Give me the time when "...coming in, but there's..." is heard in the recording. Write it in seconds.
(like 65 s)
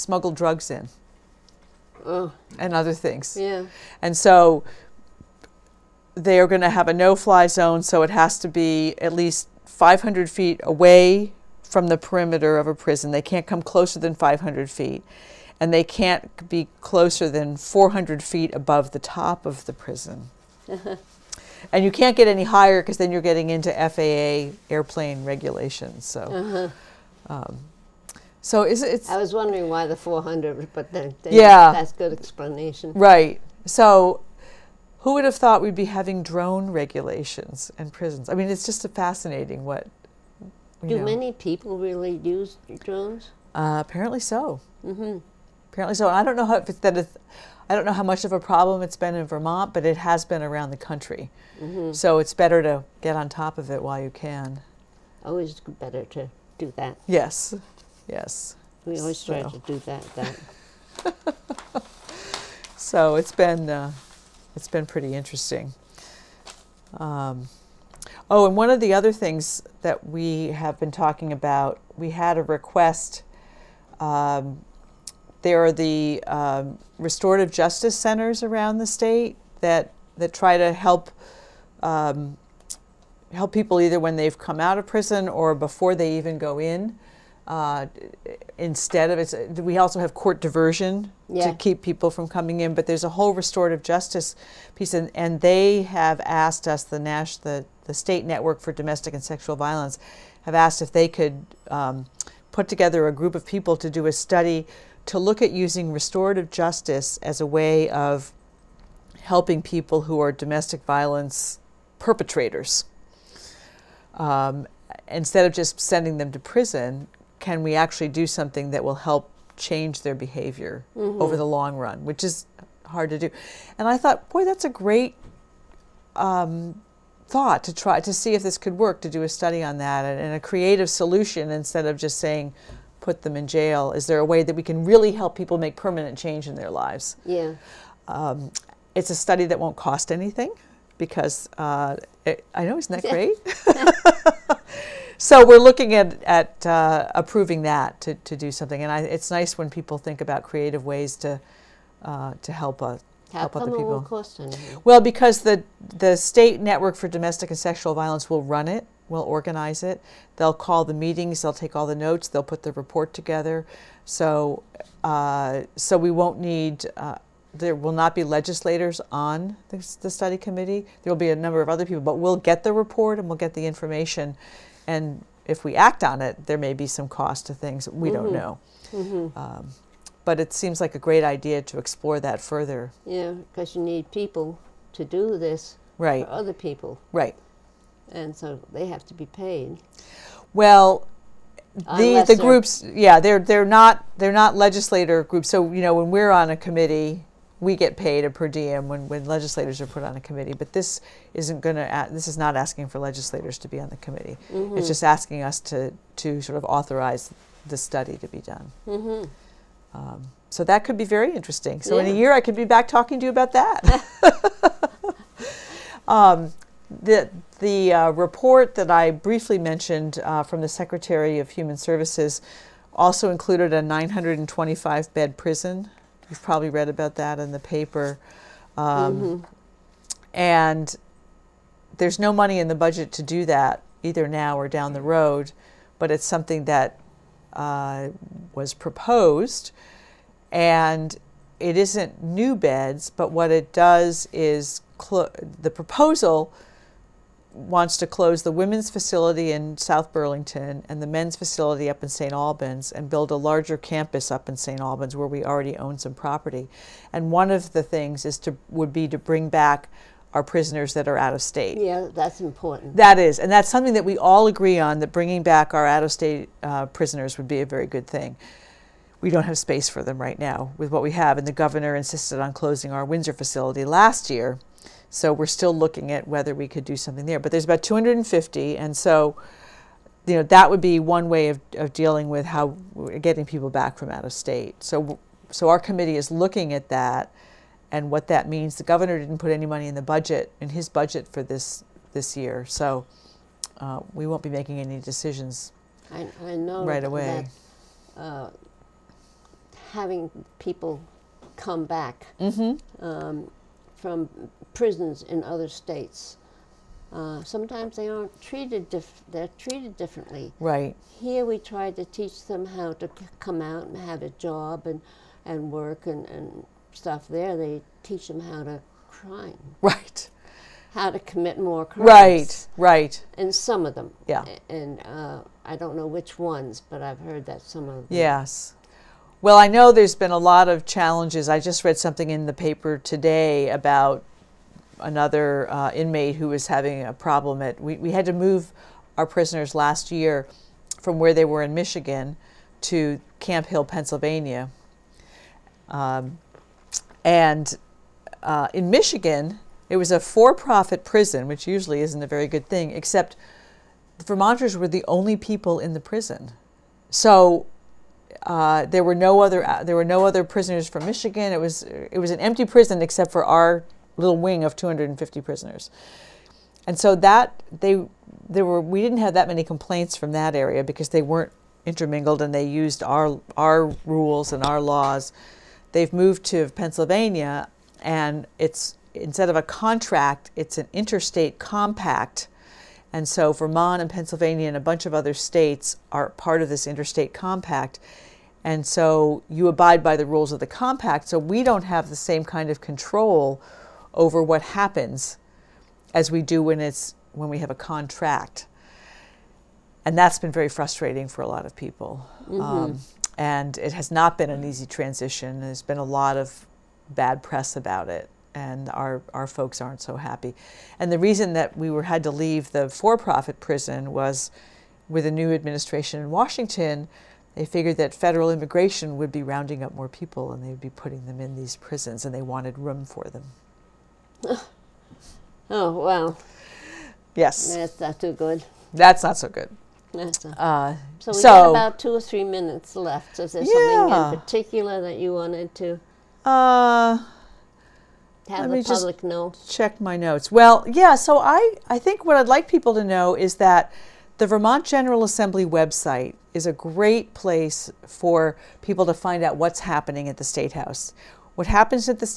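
92 s.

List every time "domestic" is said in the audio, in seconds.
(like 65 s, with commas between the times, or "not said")
98 s, 110 s, 157 s.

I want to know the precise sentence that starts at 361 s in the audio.
It was it was an empty prison except for our little wing of 250 prisoners.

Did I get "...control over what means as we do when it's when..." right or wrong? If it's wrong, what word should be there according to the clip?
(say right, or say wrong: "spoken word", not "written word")
wrong: "happens", not "means".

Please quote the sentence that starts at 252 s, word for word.
Albans and build a larger campus up in St.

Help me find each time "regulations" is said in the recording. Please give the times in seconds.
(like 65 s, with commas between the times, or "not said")
25 s, 36 s.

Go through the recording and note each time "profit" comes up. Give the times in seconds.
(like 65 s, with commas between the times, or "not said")
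350 s, 412 s.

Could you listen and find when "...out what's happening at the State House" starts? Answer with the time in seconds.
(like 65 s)
449 s.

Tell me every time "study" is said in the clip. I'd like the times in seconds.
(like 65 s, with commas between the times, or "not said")
104 s, 129 s, 139 s, 170 s, 207 s.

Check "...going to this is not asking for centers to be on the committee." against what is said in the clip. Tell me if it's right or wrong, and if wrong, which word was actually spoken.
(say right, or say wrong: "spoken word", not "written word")
wrong: "legislators", not "centers".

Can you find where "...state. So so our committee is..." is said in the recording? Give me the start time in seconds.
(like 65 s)
284 s.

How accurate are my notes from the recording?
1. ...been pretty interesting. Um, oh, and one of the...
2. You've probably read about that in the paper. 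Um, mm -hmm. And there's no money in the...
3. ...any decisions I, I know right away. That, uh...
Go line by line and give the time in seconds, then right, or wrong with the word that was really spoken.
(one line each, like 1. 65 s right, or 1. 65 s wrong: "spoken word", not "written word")
1. 64 s right
2. 226 s right
3. 294 s right.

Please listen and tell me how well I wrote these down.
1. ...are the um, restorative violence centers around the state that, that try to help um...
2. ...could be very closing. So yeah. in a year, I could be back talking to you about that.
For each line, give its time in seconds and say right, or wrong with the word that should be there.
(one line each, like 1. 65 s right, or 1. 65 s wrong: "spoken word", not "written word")
1. 75 s wrong: "justice", not "violence"
2. 210 s wrong: "interesting", not "closing".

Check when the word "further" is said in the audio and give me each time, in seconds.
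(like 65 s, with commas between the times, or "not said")
182 s.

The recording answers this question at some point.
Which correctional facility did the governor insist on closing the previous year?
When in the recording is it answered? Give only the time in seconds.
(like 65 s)
273 s.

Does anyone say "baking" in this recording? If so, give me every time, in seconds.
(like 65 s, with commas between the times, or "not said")
not said.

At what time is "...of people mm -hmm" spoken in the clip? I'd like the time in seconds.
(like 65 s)
401 s.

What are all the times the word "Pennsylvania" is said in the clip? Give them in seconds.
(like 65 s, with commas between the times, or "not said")
343 s, 376 s, 384 s.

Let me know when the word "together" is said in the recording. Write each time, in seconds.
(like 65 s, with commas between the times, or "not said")
102 s, 163 s.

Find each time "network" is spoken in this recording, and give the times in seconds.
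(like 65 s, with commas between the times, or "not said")
98 s, 156 s.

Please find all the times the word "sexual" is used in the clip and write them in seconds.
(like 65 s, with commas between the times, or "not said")
99 s, 157 s.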